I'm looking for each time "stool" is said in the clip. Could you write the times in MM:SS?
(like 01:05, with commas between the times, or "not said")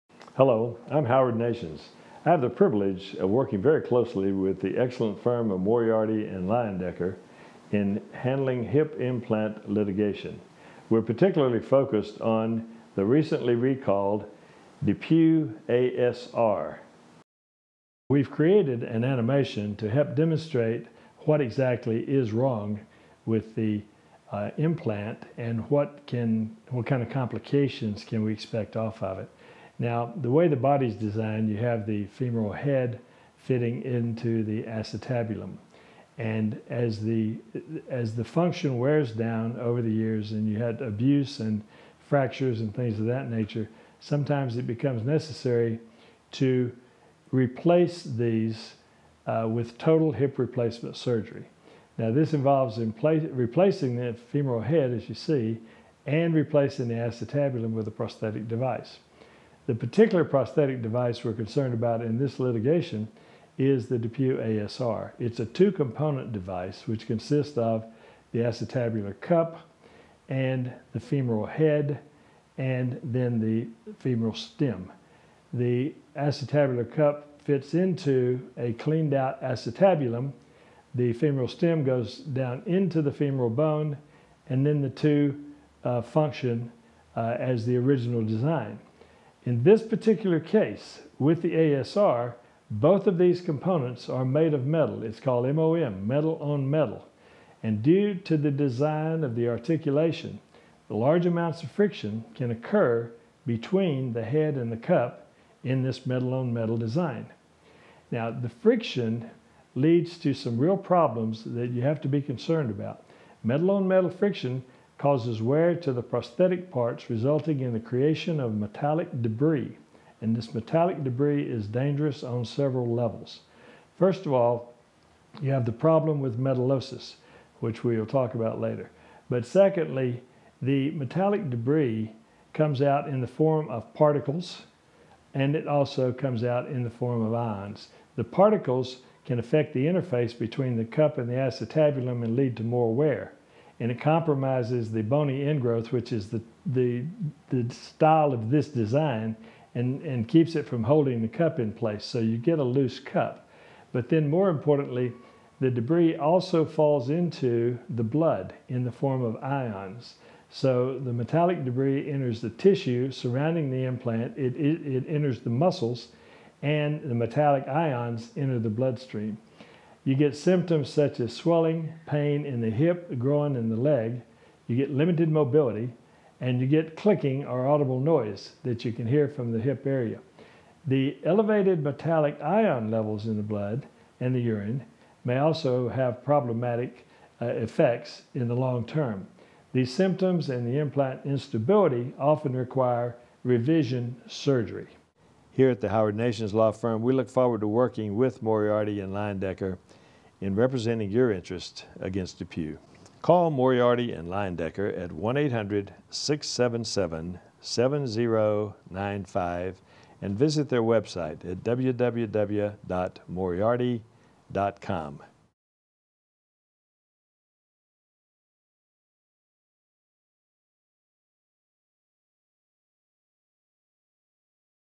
not said.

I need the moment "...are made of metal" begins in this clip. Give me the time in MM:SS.
01:34.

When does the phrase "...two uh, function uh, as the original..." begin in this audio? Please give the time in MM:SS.
01:24.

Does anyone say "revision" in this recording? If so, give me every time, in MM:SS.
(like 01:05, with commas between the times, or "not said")
03:13.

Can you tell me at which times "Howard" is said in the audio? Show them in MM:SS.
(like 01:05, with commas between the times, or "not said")
00:01, 03:15.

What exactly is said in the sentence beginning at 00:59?
The particular prosthetic device we're concerned about in this litigation is the DePuy ASR.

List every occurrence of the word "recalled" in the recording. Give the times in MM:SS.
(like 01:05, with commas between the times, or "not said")
00:13.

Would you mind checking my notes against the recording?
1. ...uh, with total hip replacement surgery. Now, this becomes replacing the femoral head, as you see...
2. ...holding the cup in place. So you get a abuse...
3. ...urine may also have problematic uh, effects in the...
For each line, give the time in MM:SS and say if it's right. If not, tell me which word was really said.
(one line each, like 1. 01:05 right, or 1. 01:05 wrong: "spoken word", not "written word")
1. 00:49 wrong: "involves", not "becomes"
2. 02:30 wrong: "loose", not "abuse"
3. 03:04 right.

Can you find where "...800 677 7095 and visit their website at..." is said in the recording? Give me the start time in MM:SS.
03:25.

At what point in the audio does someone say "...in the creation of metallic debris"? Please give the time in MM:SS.
01:57.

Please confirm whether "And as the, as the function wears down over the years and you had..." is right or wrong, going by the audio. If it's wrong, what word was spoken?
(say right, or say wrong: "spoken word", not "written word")
right.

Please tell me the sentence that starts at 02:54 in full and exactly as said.
You get limited mobility, and you get clicking or audible noise that you can hear from the hip area.